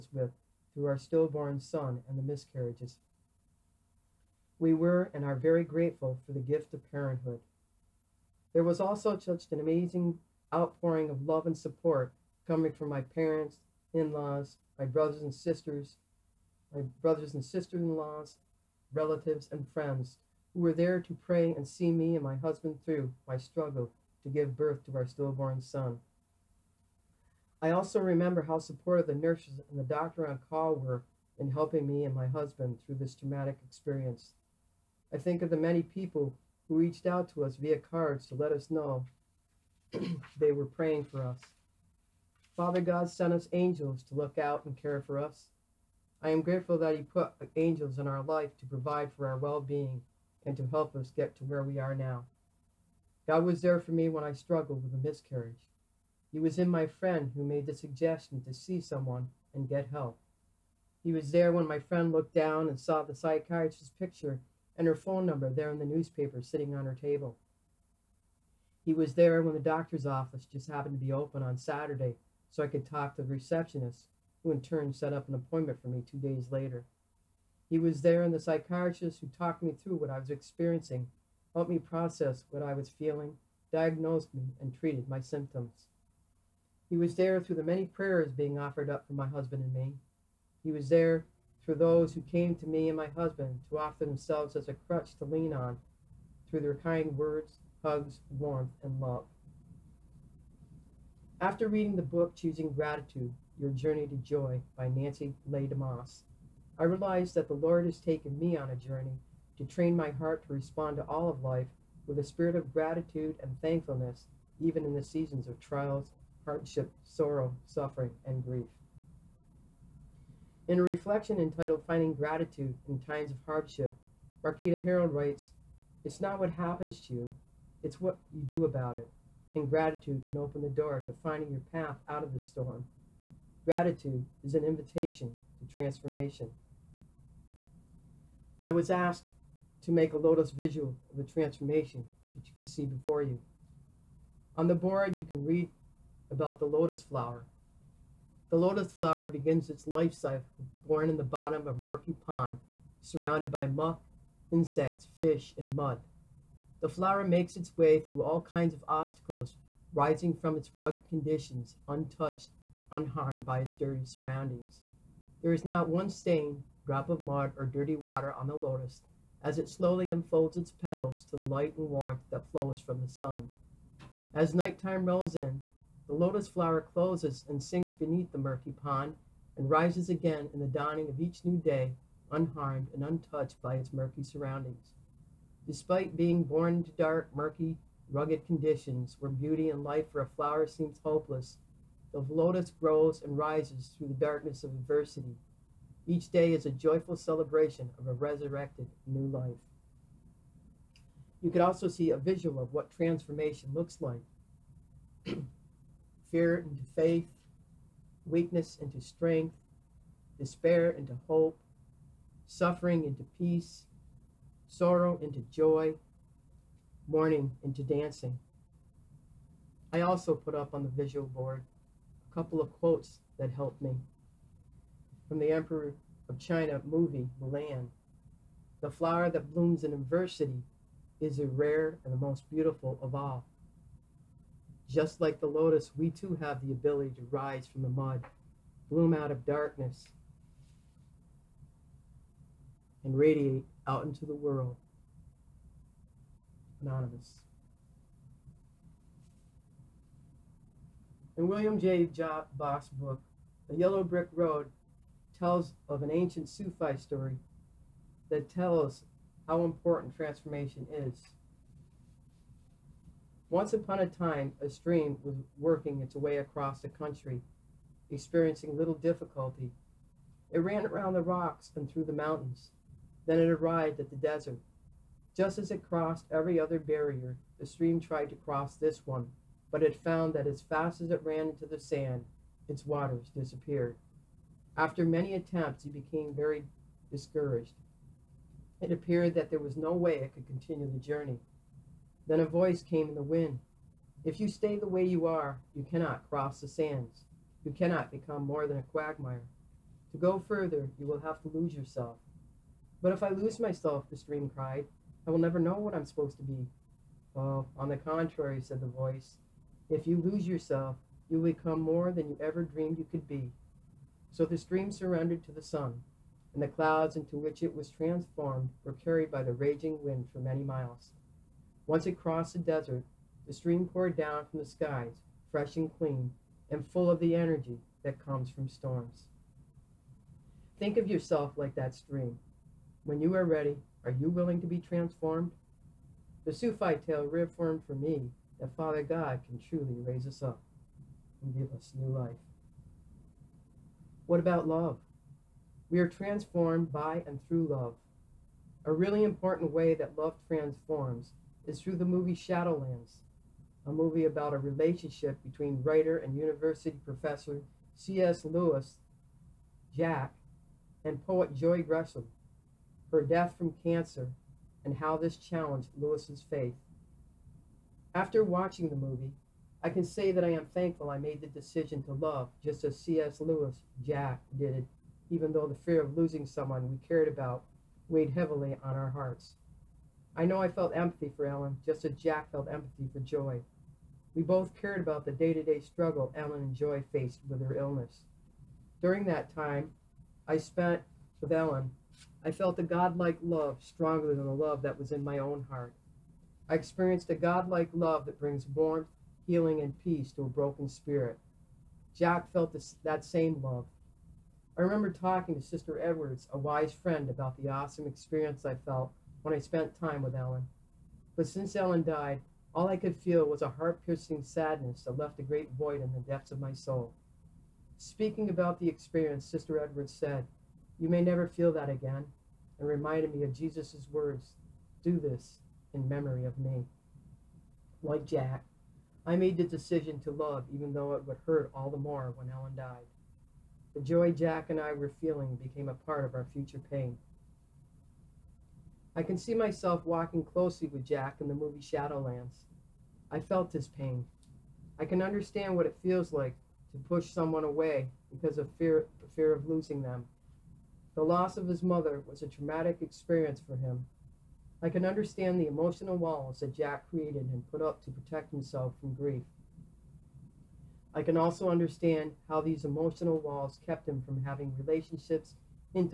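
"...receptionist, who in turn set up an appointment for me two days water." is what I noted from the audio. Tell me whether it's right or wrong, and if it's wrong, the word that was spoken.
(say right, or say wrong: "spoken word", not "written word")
wrong: "later", not "water".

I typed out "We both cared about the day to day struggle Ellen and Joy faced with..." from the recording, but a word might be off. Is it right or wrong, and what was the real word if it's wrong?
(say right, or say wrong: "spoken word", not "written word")
right.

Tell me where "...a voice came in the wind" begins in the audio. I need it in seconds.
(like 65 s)
292 s.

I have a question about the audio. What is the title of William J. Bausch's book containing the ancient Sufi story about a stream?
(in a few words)
The Yellow Brick Road.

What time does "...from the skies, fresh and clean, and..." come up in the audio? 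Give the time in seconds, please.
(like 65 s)
324 s.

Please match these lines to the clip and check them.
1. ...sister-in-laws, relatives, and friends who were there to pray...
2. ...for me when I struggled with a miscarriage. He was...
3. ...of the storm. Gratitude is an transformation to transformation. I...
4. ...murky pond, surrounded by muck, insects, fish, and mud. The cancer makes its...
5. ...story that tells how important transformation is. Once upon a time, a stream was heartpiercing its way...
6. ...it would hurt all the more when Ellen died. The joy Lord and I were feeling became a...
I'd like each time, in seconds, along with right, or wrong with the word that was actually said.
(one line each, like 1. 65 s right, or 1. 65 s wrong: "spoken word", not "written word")
1. 17 s right
2. 53 s right
3. 132 s wrong: "invitation", not "transformation"
4. 151 s wrong: "flower", not "cancer"
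5. 256 s wrong: "working", not "heartpiercing"
6. 431 s wrong: "Jack", not "Lord".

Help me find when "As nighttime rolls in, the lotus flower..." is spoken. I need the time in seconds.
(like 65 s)
174 s.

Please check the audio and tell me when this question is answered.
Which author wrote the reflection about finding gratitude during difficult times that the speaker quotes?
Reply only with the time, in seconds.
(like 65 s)
124 s.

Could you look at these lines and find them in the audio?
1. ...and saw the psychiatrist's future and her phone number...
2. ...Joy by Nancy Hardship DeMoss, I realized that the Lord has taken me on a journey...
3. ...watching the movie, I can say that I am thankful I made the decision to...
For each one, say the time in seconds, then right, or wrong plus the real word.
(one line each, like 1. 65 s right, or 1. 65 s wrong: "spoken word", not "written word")
1. 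62 s wrong: "picture", not "future"
2. 104 s wrong: "Leigh", not "Hardship"
3. 368 s right.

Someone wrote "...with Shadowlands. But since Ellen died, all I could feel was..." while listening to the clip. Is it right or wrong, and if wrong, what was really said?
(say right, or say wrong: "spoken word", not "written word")
wrong: "Ellen", not "Shadowlands".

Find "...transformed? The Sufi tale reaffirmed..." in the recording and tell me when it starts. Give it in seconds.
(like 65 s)
334 s.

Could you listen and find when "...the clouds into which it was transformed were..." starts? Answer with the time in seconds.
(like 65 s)
316 s.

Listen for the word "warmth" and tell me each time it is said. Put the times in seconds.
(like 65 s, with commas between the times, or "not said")
98 s, 171 s, 398 s.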